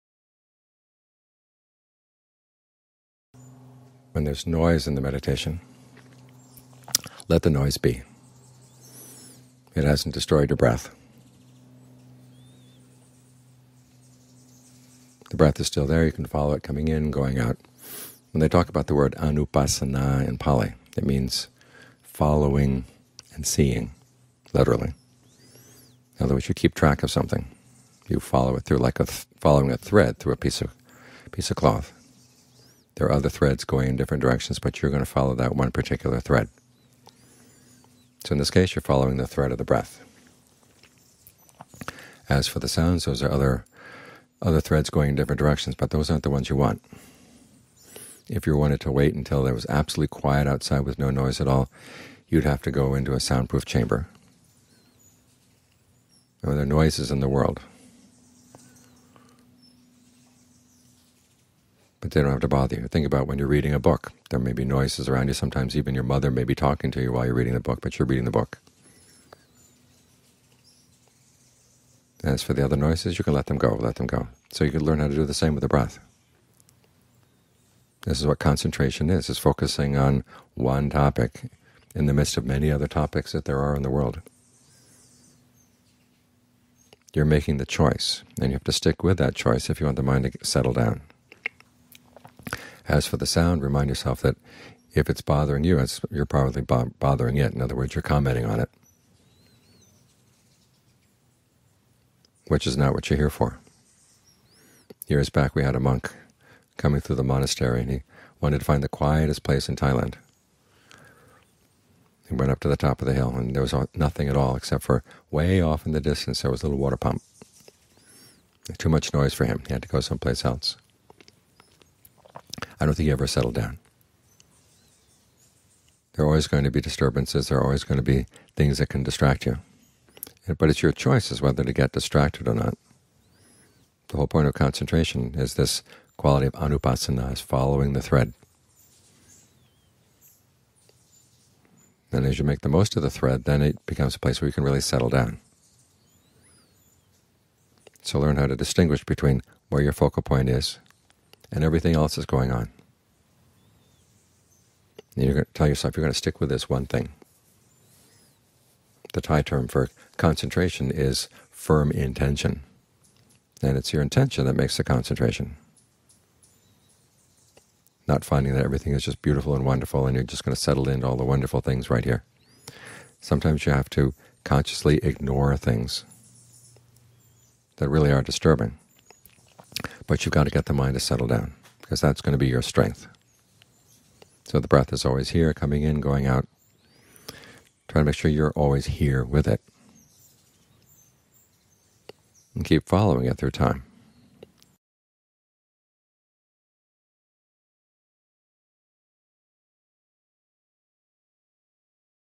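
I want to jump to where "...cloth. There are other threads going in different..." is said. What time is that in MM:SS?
00:31.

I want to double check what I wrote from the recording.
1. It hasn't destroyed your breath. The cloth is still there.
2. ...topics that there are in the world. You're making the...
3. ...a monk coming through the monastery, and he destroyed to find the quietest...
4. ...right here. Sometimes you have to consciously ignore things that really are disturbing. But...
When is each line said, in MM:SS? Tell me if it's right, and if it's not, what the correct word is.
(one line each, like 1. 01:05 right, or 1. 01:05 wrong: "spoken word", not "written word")
1. 00:09 wrong: "breath", not "cloth"
2. 01:22 right
3. 01:45 wrong: "wanted", not "destroyed"
4. 02:51 right.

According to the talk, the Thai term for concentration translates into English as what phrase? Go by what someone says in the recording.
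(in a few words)
firm intention.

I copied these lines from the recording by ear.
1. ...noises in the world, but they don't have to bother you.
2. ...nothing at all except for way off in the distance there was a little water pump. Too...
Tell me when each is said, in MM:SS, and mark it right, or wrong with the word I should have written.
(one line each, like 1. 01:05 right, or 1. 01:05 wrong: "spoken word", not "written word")
1. 00:56 right
2. 01:53 right.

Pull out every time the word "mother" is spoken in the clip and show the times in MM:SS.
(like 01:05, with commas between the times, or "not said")
01:06.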